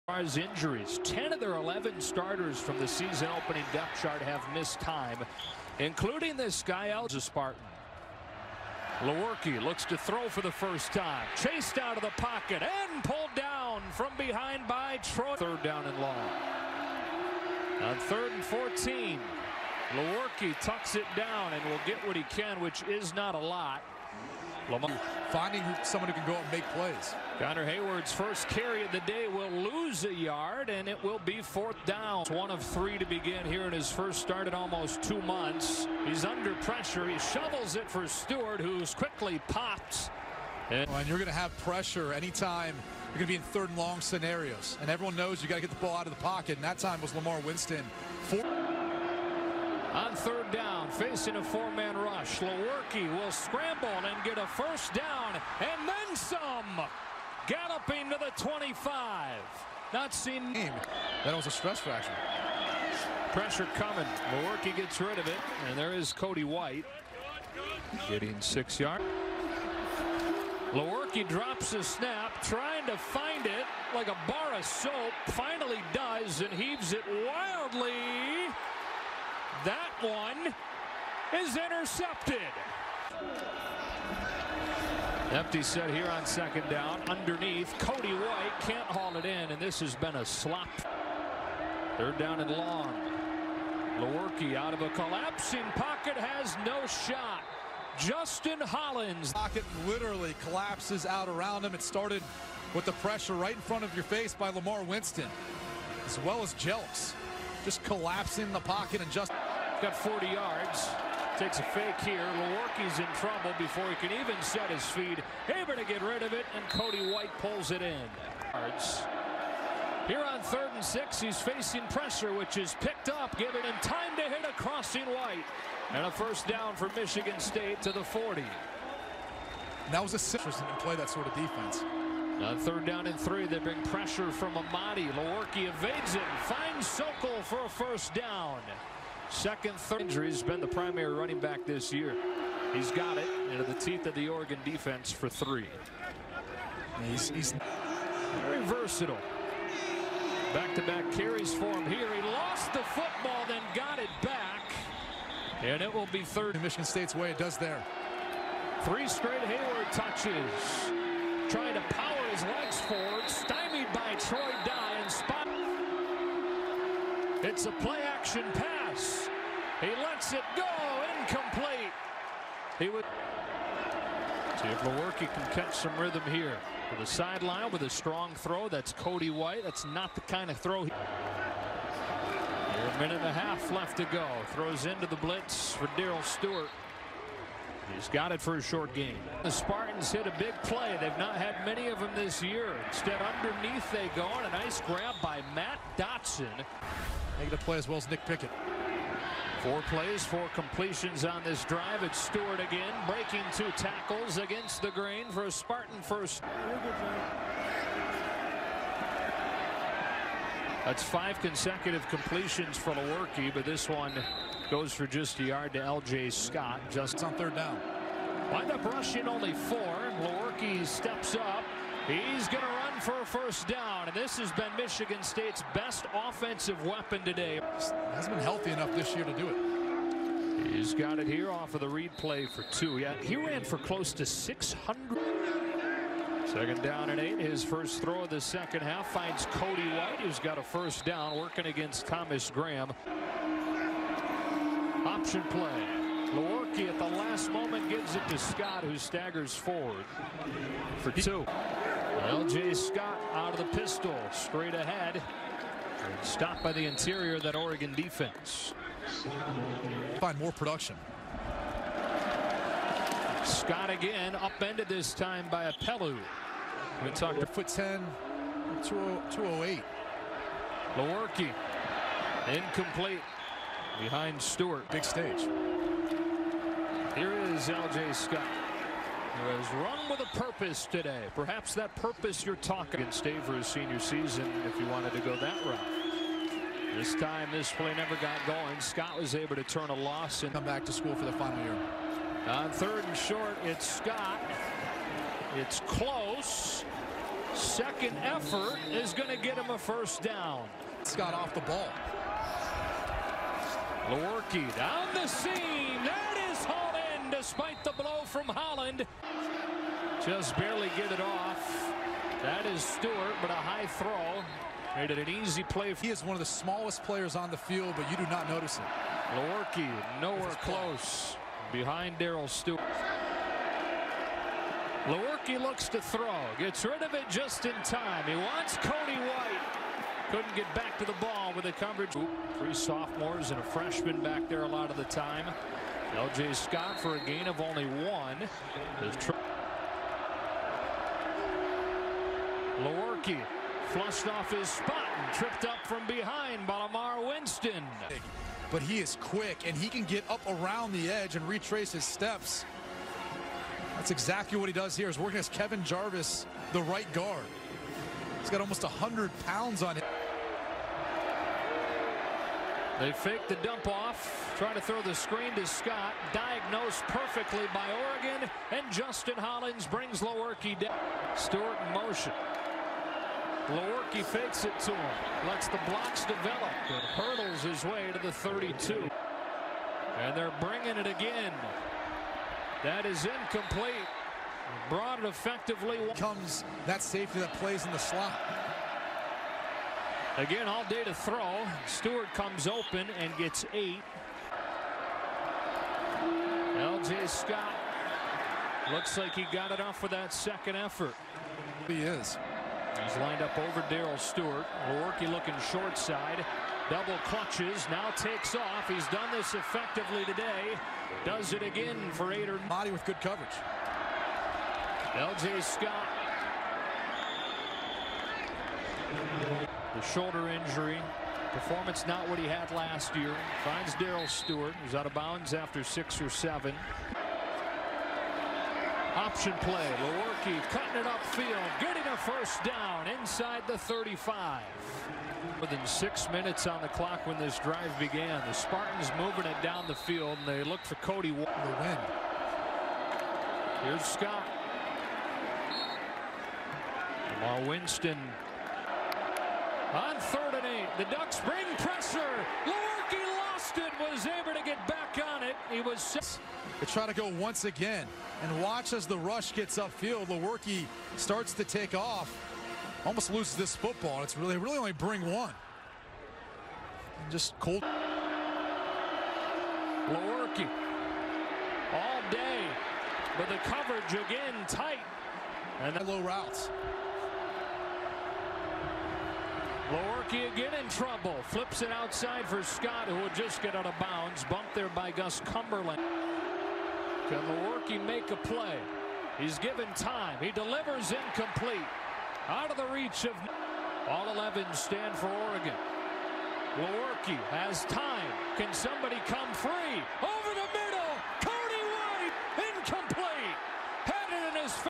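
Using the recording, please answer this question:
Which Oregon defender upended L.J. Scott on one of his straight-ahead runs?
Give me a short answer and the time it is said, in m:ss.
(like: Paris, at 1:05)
Apelu, at 4:25.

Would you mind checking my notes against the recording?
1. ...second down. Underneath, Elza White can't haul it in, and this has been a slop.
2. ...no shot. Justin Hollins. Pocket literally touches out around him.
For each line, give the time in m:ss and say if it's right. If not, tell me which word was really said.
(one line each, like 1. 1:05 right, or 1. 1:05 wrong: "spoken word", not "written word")
1. 1:26 wrong: "Cody", not "Elza"
2. 1:36 wrong: "collapses", not "touches".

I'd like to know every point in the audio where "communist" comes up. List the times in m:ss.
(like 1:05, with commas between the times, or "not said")
not said.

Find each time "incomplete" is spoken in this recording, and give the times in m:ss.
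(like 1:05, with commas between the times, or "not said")
2:51, 4:32, 6:23, 8:11.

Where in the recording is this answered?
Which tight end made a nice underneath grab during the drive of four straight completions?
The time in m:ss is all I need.
3:15.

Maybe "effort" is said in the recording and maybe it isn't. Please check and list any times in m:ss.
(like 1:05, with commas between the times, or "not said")
4:58, 6:40.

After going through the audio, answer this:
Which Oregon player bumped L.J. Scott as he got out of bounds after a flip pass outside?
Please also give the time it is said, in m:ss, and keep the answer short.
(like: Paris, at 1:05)
Gus Cumberlander, at 8:05.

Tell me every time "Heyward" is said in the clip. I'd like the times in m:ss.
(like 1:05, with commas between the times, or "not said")
0:27, 2:39.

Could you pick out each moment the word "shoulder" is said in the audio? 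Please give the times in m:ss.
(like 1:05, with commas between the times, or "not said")
7:00.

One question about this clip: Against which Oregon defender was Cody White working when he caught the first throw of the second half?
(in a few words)
Thomas Graham.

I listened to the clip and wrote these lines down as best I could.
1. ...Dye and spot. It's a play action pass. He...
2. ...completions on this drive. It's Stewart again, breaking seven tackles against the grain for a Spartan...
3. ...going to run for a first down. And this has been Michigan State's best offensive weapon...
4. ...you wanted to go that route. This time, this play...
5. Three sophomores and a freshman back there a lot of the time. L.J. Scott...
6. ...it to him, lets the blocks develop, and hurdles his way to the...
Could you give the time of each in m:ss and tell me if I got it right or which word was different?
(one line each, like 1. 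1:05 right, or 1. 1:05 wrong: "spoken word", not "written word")
1. 2:44 right
2. 3:20 wrong: "two", not "seven"
3. 3:42 right
4. 4:44 right
5. 5:32 right
6. 6:14 right.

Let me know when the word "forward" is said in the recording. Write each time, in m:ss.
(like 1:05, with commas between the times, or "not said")
2:42, 4:09.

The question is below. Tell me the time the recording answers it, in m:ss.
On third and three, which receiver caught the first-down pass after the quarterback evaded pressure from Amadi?
2:16.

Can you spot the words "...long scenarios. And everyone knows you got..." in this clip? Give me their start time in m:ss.
0:43.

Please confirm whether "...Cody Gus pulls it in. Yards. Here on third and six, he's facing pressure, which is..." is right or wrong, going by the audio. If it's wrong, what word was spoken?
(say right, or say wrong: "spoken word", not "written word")
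wrong: "White", not "Gus".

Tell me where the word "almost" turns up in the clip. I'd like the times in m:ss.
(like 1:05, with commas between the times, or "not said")
0:34, 5:58, 7:43.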